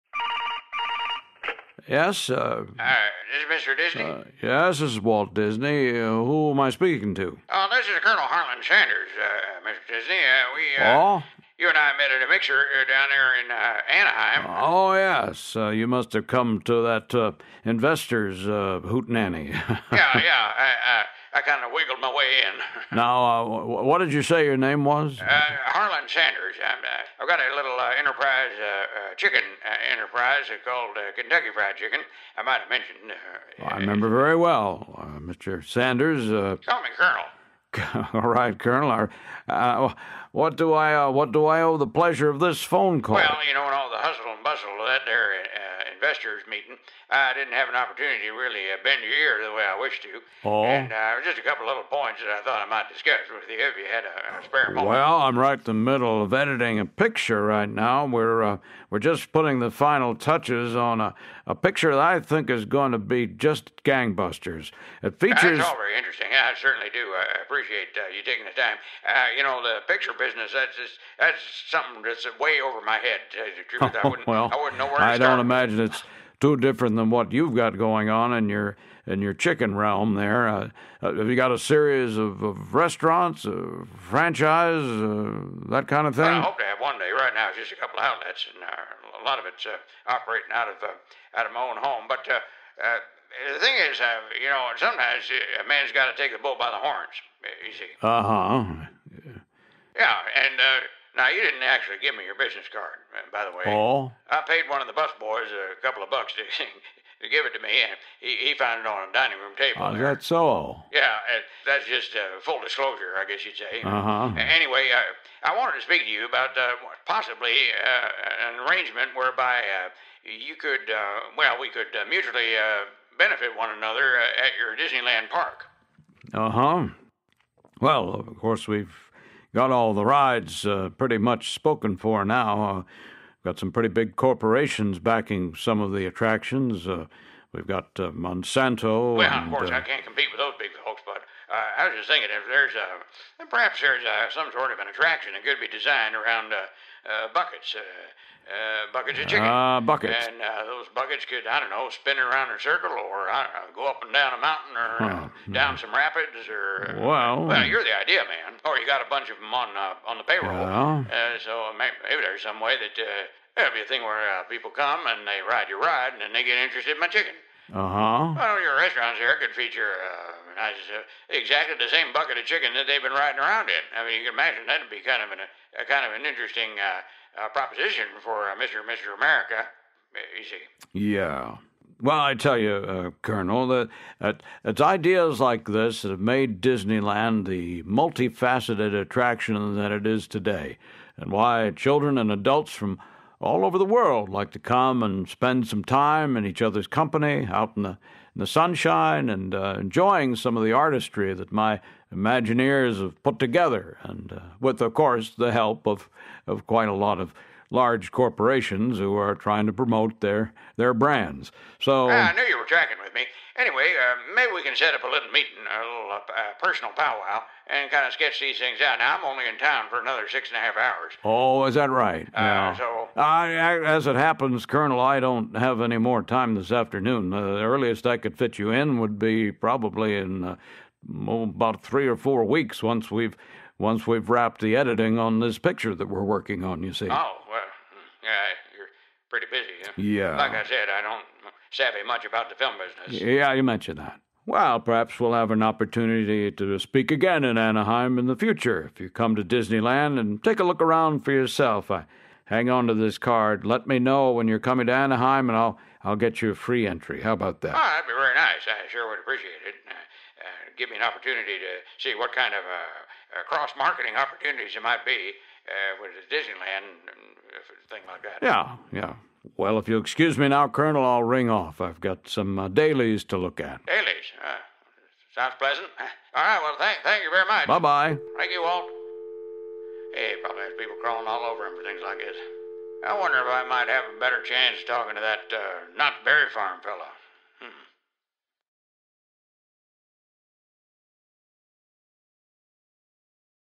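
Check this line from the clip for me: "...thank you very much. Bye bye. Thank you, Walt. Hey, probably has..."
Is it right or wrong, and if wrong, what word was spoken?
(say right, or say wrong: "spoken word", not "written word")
right.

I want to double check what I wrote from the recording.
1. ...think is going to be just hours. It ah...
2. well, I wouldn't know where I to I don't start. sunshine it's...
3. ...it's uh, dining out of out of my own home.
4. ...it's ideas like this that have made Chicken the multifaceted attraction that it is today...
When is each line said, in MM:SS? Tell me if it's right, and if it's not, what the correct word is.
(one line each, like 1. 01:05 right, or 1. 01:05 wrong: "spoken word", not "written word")
1. 01:02 wrong: "gangbusters", not "hours"
2. 01:14 wrong: "imagine", not "sunshine"
3. 01:29 wrong: "operating", not "dining"
4. 03:04 wrong: "Disneyland", not "Chicken".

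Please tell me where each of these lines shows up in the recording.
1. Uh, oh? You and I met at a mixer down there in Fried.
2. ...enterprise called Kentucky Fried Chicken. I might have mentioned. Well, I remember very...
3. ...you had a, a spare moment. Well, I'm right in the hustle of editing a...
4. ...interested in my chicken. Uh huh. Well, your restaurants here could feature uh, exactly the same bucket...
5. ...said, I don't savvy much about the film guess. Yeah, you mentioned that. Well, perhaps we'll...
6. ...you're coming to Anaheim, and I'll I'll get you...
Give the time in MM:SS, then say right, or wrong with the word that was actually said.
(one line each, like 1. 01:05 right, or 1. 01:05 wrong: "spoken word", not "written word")
1. 00:10 wrong: "Anaheim", not "Fried"
2. 00:29 right
3. 00:53 wrong: "middle", not "hustle"
4. 02:46 right
5. 04:00 wrong: "business", not "guess"
6. 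04:14 right.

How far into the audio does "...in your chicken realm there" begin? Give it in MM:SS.
01:19.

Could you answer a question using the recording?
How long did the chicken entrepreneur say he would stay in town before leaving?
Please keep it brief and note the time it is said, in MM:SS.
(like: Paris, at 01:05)
6 and a half hours, at 03:40.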